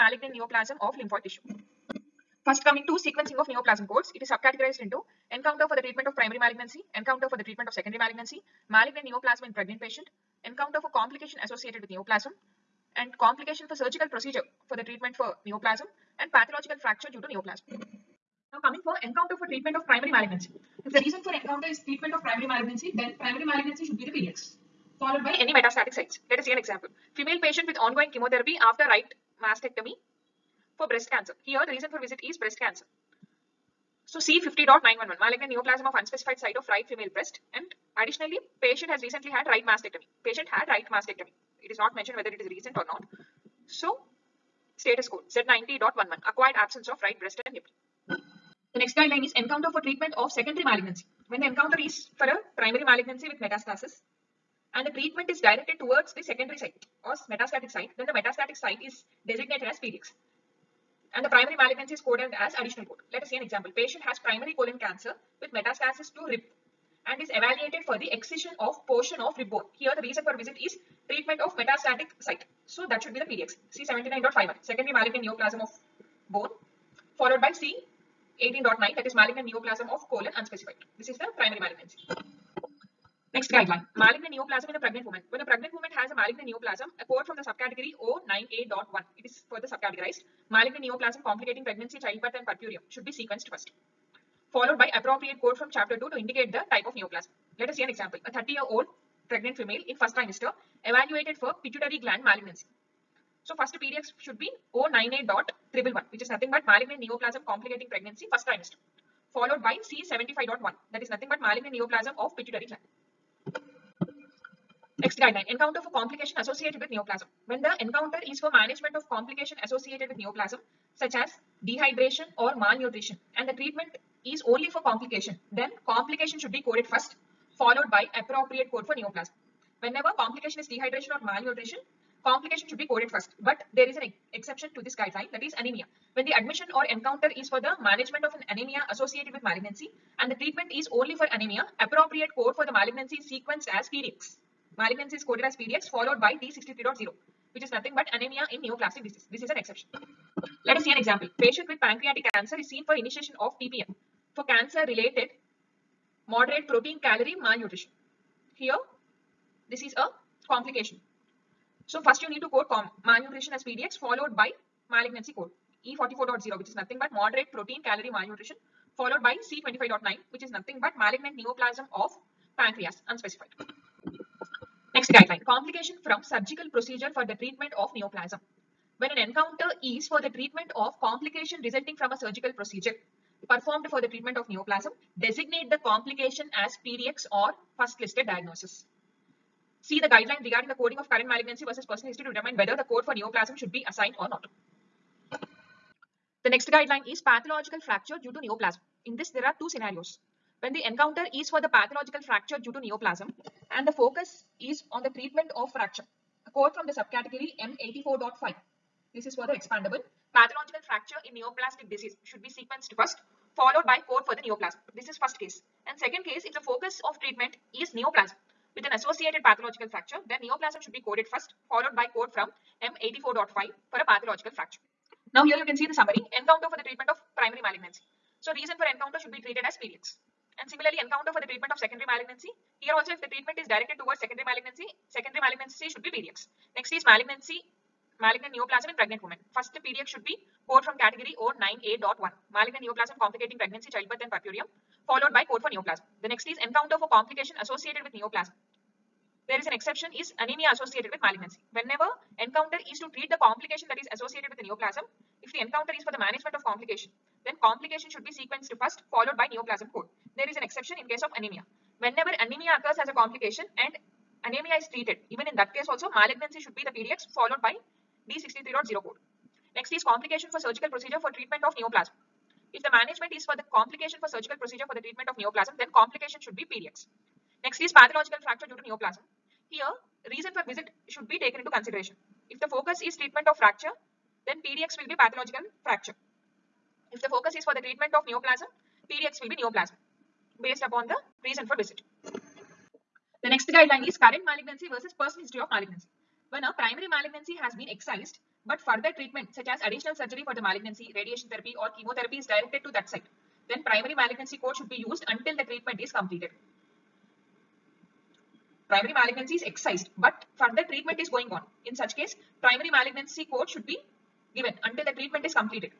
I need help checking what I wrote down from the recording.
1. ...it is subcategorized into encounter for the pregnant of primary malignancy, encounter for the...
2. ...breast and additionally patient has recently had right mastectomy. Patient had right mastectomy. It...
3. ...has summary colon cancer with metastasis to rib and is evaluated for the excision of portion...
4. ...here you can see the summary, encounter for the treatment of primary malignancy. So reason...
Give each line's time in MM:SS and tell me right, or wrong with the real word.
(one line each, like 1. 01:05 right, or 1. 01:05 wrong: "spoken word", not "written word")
1. 00:04 wrong: "treatment", not "pregnant"
2. 00:37 right
3. 01:04 wrong: "primary", not "summary"
4. 03:45 right.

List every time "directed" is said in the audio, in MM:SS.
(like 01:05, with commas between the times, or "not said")
00:55, 03:53, 05:02.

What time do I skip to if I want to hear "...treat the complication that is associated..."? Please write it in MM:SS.
04:13.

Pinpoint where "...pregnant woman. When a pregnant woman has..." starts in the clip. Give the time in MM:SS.
01:24.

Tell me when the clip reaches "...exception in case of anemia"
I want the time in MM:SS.
04:20.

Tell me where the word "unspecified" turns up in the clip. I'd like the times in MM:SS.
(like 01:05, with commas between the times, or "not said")
00:35, 01:20, 02:53.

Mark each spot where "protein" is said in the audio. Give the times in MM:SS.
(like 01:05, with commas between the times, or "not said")
02:36, 02:47.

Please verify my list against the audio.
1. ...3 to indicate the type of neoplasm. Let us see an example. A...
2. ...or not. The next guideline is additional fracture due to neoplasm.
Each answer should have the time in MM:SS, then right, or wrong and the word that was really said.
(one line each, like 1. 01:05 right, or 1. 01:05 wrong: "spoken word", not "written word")
1. 01:35 wrong: "2", not "3"
2. 03:14 wrong: "pathological", not "additional".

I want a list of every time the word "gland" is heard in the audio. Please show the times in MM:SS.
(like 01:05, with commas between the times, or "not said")
01:42, 01:52.